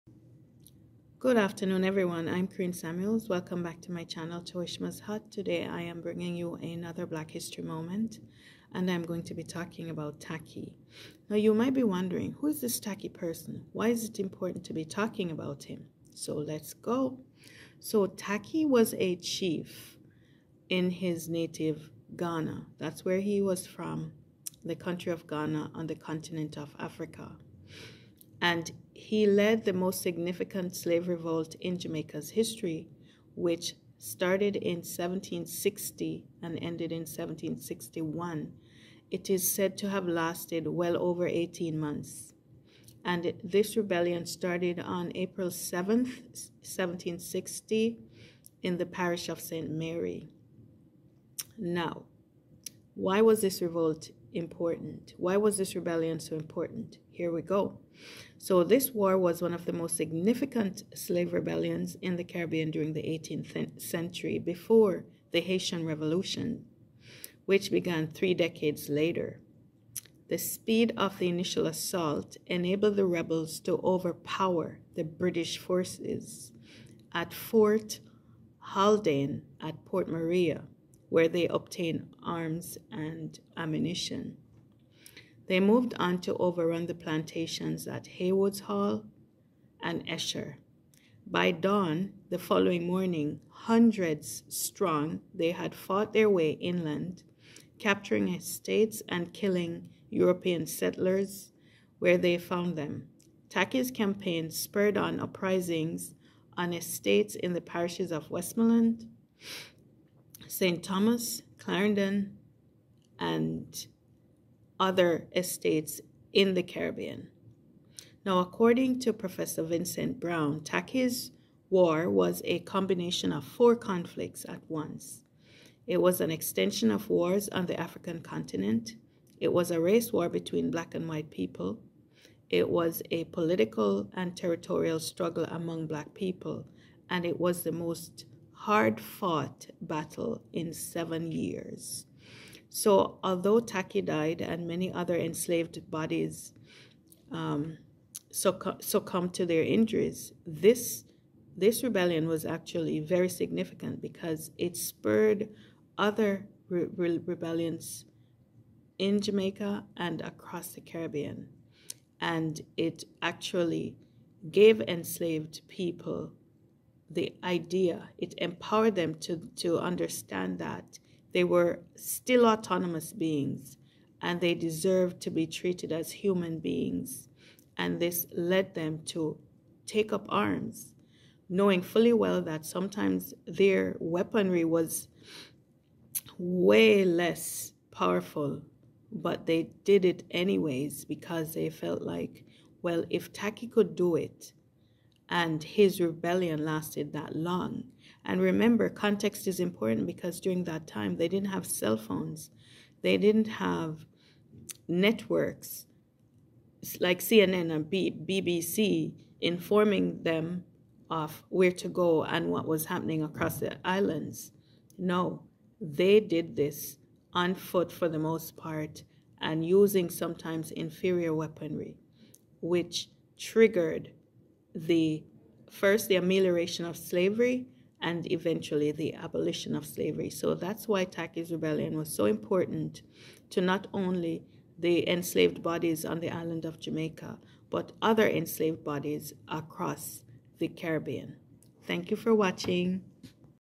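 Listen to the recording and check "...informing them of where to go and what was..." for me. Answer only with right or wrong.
right.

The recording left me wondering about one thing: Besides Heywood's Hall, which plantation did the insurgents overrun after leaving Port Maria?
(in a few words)
Esher.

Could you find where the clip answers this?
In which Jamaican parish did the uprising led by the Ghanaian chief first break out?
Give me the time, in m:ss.
0:49.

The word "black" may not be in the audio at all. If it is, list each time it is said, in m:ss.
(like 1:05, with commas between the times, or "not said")
0:07, 2:10, 2:15.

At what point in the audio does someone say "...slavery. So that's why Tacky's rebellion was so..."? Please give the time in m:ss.
3:49.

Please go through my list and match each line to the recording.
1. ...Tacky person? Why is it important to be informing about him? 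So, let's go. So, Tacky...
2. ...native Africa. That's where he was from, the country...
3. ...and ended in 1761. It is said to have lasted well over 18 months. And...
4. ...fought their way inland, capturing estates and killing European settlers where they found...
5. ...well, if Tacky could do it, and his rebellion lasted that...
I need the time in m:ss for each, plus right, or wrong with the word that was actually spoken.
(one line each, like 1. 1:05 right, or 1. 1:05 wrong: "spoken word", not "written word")
1. 0:12 wrong: "talking", not "informing"
2. 0:21 wrong: "Ghana", not "Africa"
3. 0:36 right
4. 1:35 right
5. 3:12 right.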